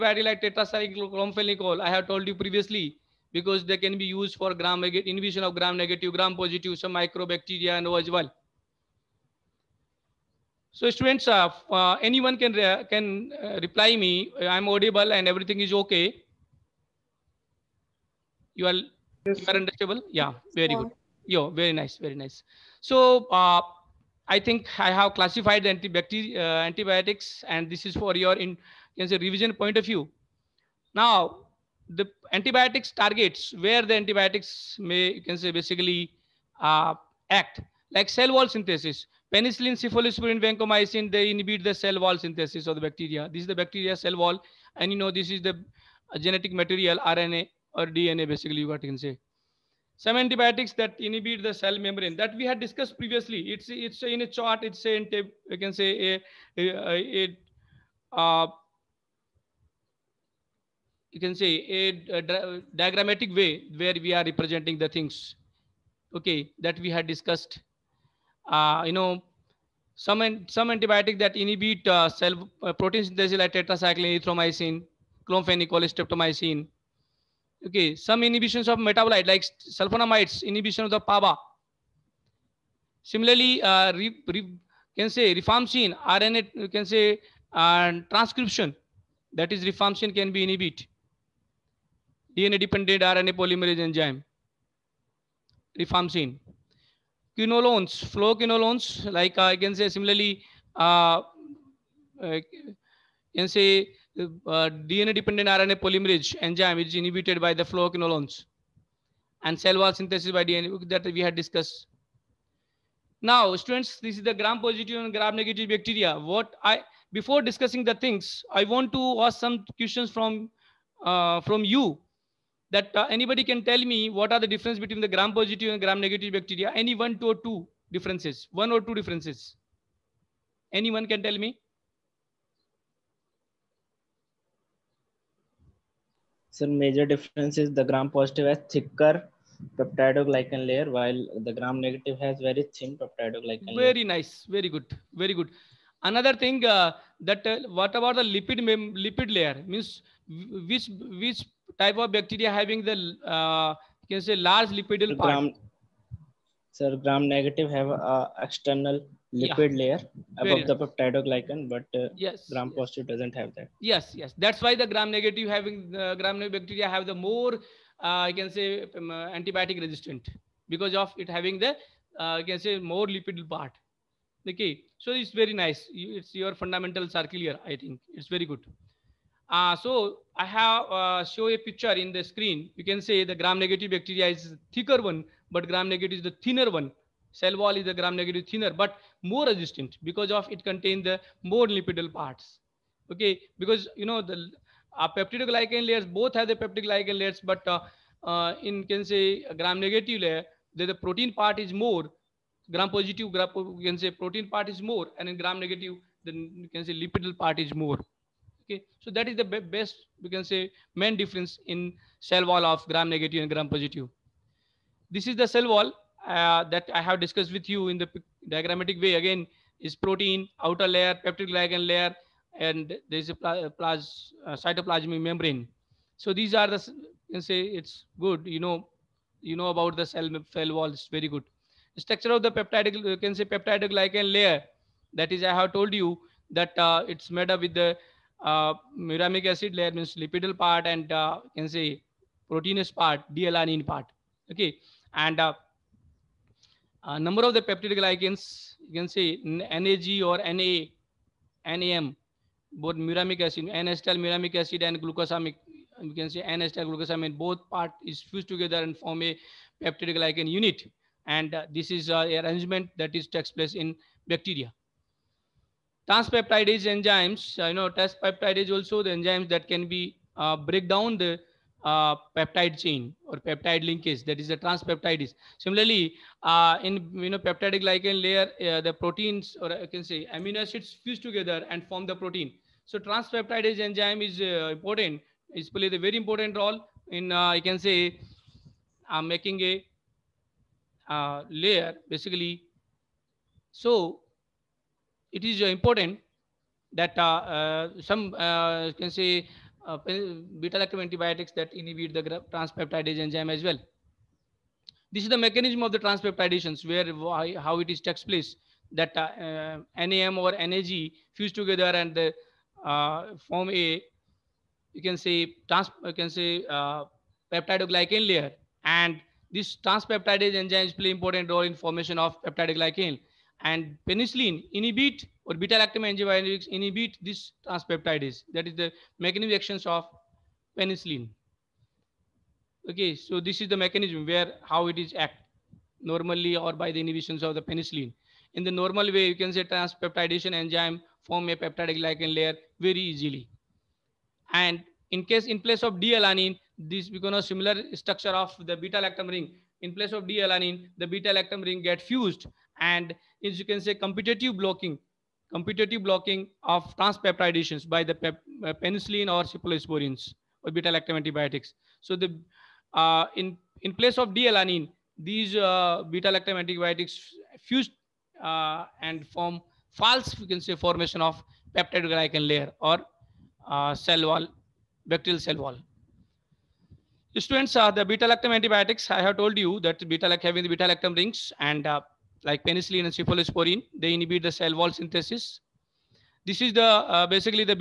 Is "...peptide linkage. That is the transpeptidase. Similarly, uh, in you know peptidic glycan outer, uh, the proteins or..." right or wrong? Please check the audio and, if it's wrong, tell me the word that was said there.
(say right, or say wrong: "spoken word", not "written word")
wrong: "layer", not "outer".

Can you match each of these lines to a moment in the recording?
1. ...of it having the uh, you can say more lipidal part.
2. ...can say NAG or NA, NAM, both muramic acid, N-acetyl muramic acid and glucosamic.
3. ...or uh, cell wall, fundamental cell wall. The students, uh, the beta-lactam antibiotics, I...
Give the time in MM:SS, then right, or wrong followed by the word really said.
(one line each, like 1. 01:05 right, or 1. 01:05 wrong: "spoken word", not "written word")
1. 02:50 right
2. 04:09 right
3. 06:12 wrong: "bacterial", not "fundamental".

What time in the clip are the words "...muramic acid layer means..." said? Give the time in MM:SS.
03:58.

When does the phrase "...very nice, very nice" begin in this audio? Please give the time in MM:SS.
00:21.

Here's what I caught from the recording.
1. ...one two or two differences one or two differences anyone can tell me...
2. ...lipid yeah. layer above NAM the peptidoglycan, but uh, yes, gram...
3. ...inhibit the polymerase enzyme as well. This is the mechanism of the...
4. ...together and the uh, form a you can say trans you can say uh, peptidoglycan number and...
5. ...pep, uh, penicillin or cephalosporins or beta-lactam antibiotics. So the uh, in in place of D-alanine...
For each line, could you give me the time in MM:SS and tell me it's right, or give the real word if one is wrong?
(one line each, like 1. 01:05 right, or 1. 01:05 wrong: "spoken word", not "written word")
1. 02:07 right
2. 02:39 wrong: "Very", not "NAM"
3. 05:01 wrong: "transpeptidase", not "polymerase"
4. 05:11 wrong: "layer", not "number"
5. 05:58 right.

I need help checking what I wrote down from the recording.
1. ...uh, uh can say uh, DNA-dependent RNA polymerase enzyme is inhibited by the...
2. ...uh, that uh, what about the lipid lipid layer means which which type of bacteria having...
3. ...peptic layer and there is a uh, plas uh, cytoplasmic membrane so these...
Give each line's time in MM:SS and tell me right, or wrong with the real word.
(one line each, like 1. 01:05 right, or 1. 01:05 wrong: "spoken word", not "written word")
1. 01:40 right
2. 02:26 right
3. 03:41 right.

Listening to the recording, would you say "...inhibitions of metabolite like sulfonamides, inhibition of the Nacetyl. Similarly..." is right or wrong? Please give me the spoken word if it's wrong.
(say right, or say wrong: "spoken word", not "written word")
wrong: "PABA", not "Nacetyl".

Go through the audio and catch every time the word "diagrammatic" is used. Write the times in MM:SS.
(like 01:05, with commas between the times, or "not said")
01:02, 03:38.